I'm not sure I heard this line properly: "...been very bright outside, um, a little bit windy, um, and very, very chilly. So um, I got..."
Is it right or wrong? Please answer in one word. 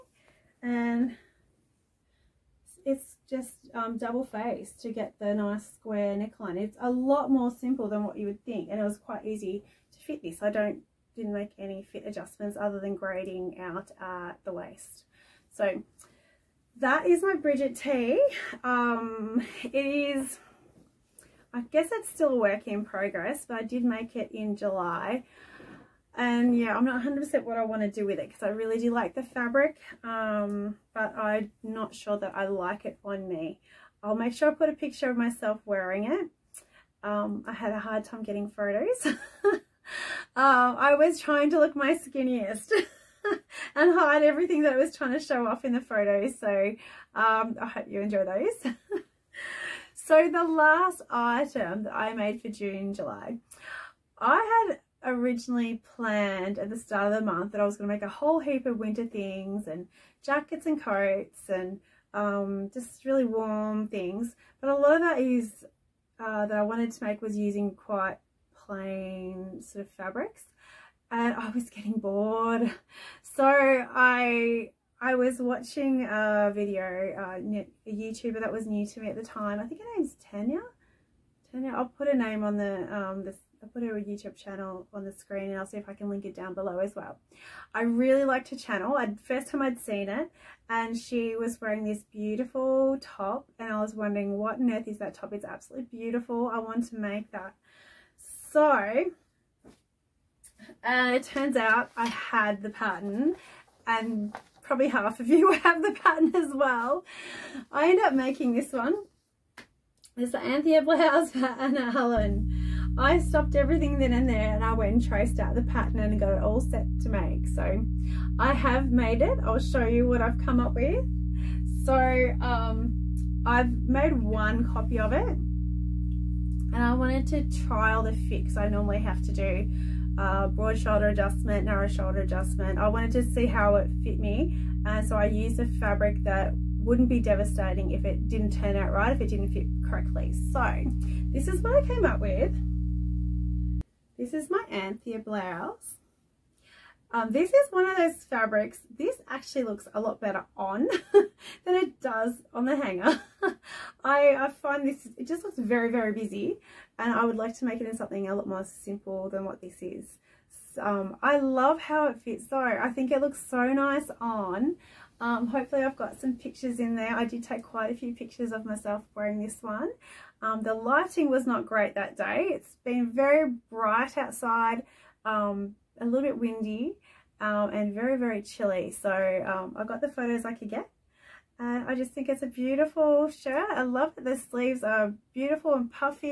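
right.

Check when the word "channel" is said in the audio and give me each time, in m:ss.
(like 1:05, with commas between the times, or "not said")
1:24, 1:28.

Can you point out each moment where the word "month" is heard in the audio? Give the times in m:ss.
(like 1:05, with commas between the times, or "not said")
0:57.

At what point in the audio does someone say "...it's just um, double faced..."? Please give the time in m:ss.
0:02.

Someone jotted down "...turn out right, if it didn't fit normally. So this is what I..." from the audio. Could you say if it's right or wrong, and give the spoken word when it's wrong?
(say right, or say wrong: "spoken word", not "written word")
wrong: "correctly", not "normally".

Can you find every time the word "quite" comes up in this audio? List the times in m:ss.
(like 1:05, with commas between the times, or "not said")
0:08, 1:07, 2:47.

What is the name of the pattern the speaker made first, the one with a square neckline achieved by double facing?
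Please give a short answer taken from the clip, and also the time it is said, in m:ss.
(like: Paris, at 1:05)
Brigit T, at 0:17.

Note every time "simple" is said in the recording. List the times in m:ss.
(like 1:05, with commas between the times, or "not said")
0:07, 2:38.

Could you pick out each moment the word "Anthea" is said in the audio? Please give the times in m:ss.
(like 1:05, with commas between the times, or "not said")
1:50, 2:24.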